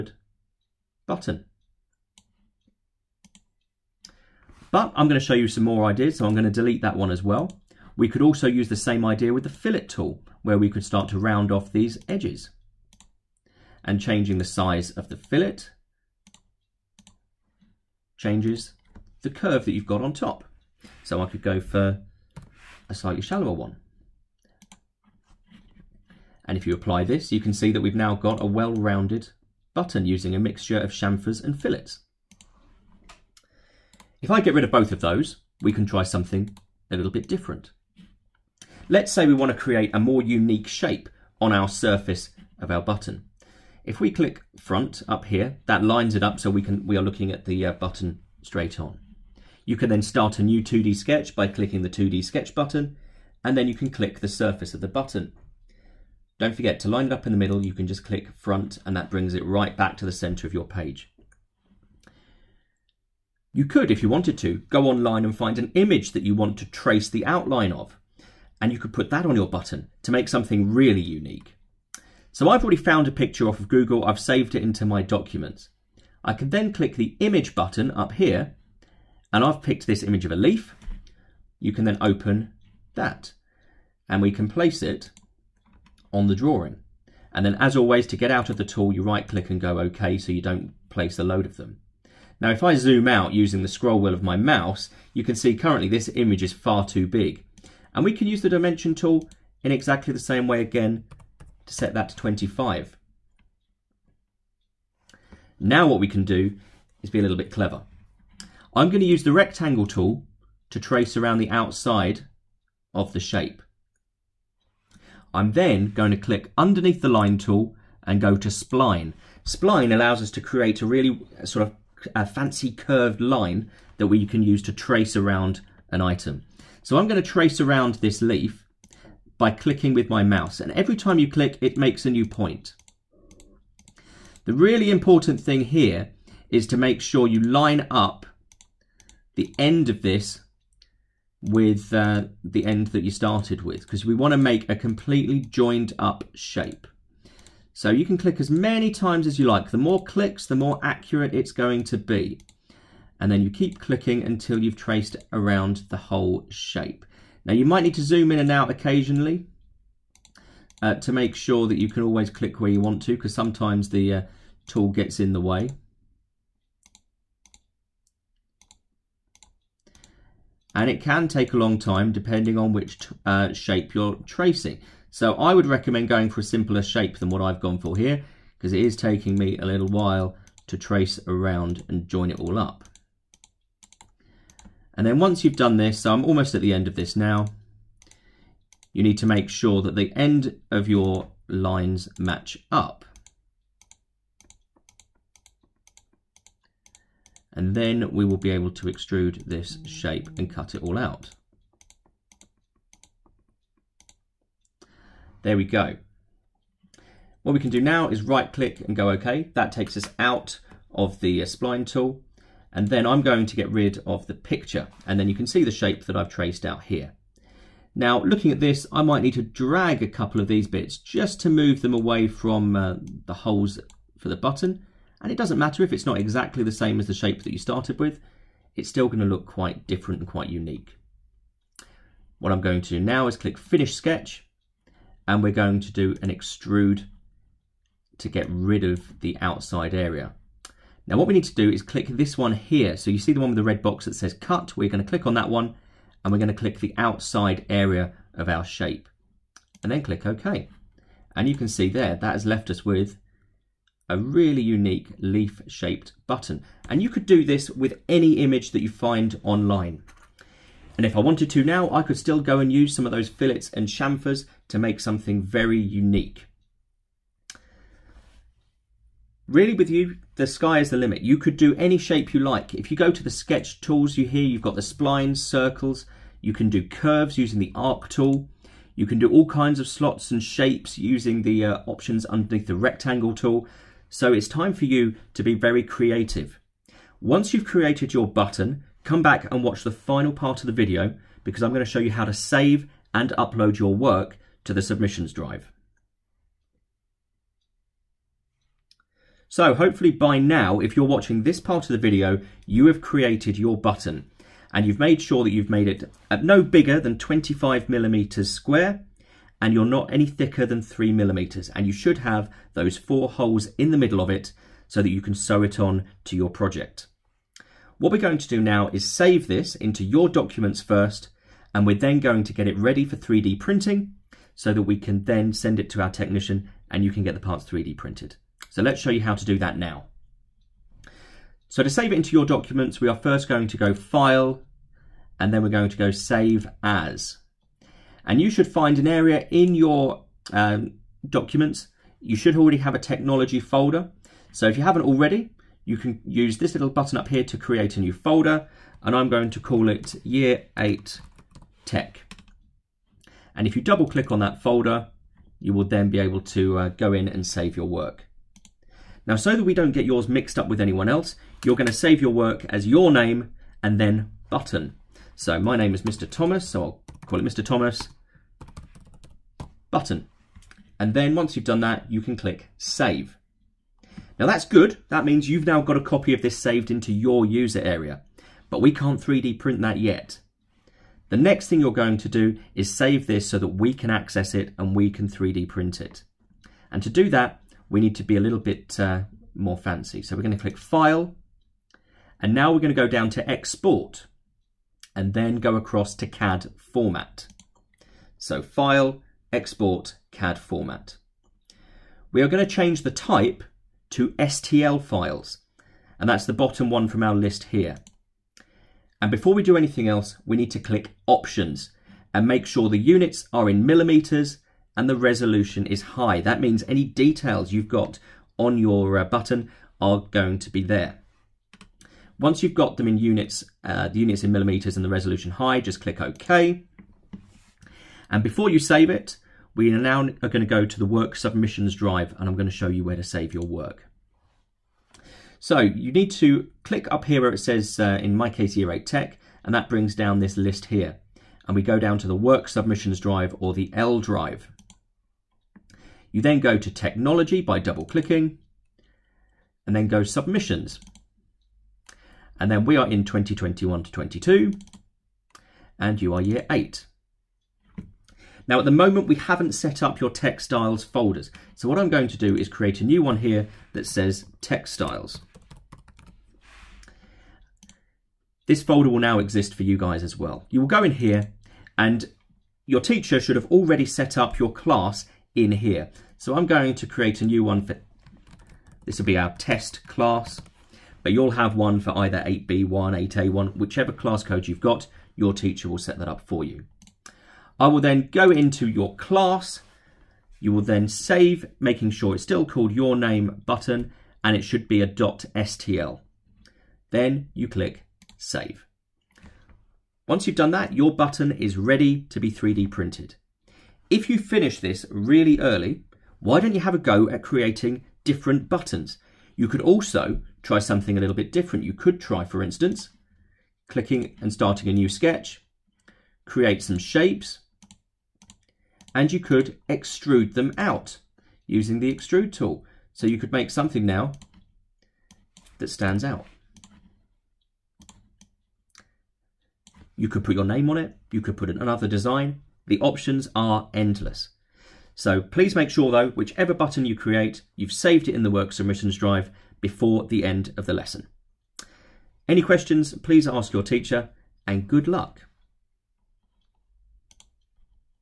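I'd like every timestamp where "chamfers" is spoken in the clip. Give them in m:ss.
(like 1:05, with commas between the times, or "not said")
0:30, 4:23.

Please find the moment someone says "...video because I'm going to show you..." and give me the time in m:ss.
4:50.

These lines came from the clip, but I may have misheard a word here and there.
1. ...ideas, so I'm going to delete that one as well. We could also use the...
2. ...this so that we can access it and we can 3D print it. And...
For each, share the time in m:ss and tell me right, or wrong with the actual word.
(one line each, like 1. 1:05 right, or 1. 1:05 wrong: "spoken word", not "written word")
1. 0:05 right
2. 6:23 right.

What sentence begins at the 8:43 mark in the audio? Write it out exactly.
So you could make something now that stands out.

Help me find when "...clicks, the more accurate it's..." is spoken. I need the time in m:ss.
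2:30.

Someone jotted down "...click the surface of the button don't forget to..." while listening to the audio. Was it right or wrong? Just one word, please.
right.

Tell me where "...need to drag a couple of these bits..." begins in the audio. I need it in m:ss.
3:39.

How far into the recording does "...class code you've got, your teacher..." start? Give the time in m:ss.
8:04.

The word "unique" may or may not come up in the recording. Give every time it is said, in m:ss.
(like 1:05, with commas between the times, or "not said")
0:40, 1:11, 3:50, 4:14, 4:25.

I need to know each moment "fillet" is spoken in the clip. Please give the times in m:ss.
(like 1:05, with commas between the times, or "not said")
0:09, 0:15, 0:31, 4:23.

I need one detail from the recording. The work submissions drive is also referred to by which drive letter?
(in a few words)
L drive.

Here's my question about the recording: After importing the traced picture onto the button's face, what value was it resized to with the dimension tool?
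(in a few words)
25.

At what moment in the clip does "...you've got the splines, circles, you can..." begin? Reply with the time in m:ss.
4:34.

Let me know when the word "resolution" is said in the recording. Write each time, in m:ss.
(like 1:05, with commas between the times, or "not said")
6:55, 7:05.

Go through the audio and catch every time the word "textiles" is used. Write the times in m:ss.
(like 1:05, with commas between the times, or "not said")
7:40, 7:44.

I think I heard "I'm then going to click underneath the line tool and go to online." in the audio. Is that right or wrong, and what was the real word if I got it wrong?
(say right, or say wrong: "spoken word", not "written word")
wrong: "spline", not "online".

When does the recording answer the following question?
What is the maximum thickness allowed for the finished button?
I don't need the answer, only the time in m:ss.
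5:10.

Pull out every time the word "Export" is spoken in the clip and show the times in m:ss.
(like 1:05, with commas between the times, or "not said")
6:33, 6:39.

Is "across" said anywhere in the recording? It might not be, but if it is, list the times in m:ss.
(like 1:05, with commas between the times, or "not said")
6:35.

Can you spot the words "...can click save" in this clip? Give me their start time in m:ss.
6:12.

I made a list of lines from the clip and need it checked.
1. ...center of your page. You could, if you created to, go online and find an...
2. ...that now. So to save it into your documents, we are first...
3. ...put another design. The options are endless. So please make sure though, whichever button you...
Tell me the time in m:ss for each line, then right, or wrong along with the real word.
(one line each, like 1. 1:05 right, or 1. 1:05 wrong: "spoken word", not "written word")
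1. 1:00 wrong: "wanted", not "created"
2. 5:29 right
3. 8:51 right.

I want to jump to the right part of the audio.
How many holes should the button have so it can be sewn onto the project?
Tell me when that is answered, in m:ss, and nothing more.
5:12.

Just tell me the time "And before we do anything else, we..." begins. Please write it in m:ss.
6:49.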